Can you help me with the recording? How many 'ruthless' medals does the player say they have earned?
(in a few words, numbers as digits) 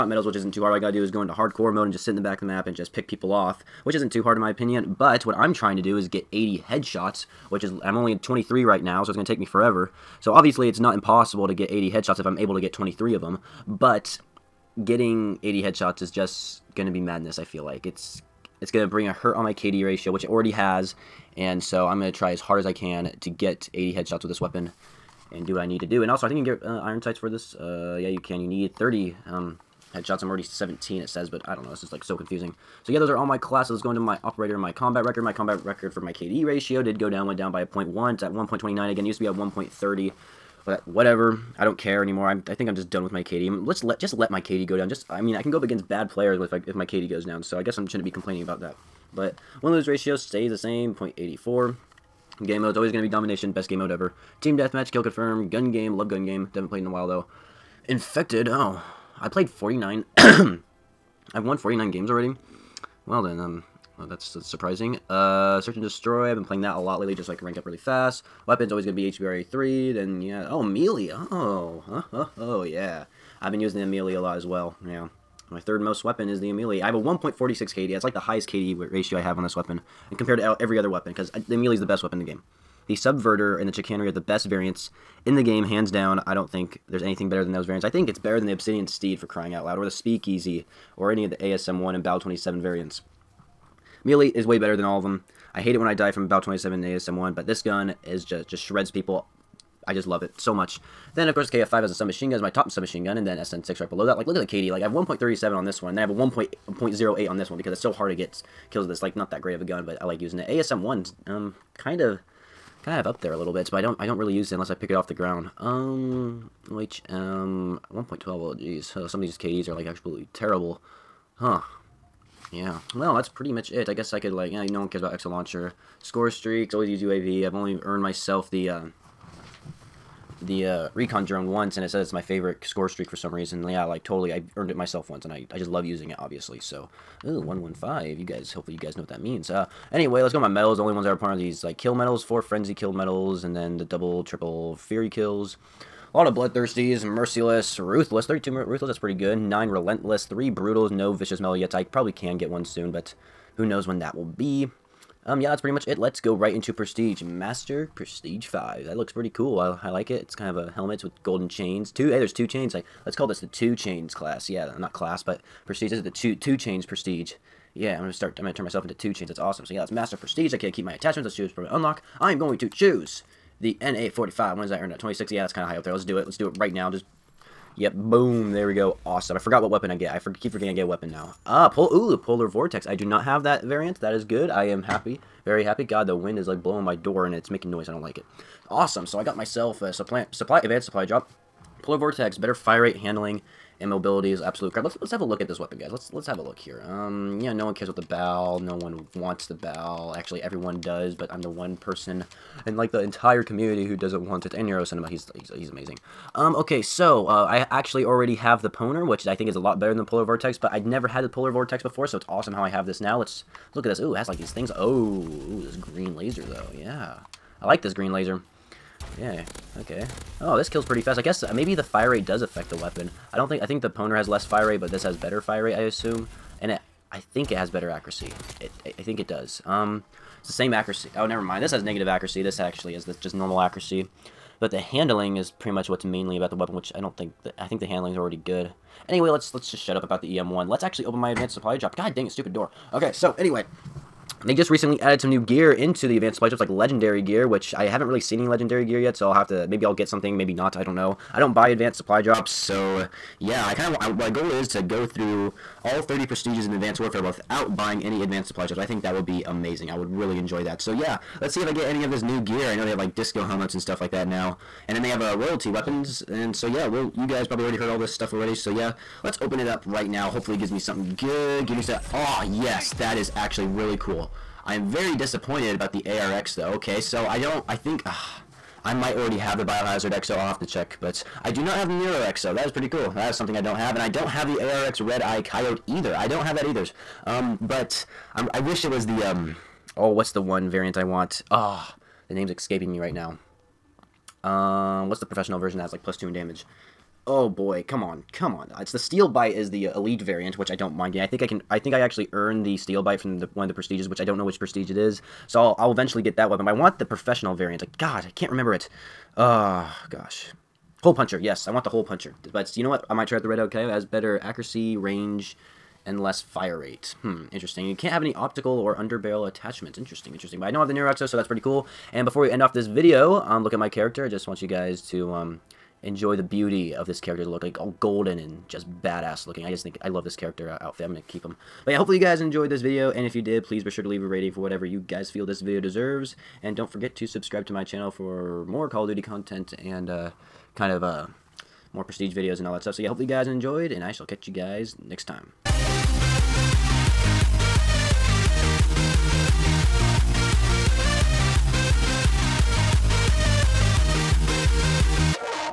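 32.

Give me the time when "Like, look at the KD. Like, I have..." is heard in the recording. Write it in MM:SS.
01:44.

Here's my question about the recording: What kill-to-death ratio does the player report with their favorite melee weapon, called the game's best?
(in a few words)
1.46.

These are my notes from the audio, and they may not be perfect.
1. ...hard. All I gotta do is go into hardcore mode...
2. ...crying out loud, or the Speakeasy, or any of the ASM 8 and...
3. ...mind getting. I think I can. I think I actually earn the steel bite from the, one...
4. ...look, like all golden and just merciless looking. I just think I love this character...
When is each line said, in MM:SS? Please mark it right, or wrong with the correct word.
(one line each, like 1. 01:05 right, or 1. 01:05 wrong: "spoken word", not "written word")
1. 00:00 right
2. 01:29 wrong: "1", not "8"
3. 05:00 right
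4. 05:27 wrong: "badass", not "merciless".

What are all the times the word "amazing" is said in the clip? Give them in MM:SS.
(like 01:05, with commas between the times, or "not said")
03:25, 04:19.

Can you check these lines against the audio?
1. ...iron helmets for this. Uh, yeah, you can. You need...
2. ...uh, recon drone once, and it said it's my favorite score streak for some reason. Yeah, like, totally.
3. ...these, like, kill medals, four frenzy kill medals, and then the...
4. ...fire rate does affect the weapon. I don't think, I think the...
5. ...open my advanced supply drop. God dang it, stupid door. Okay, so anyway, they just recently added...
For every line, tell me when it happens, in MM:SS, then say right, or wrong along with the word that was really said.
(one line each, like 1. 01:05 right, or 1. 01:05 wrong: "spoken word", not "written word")
1. 00:26 wrong: "sights", not "helmets"
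2. 02:10 right
3. 02:21 right
4. 03:41 right
5. 04:01 right.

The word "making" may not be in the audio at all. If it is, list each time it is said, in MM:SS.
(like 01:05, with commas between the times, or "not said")
03:07.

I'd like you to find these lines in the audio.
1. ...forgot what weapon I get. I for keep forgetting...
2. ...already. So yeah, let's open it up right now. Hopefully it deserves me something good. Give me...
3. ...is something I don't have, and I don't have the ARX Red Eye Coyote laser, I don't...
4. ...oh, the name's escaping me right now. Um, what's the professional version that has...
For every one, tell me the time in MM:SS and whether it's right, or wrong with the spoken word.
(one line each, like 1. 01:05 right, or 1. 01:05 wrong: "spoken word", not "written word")
1. 02:59 right
2. 04:28 wrong: "gives", not "deserves"
3. 04:43 wrong: "either", not "laser"
4. 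04:51 right.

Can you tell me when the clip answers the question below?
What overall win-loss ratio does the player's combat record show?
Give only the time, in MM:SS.
00:50.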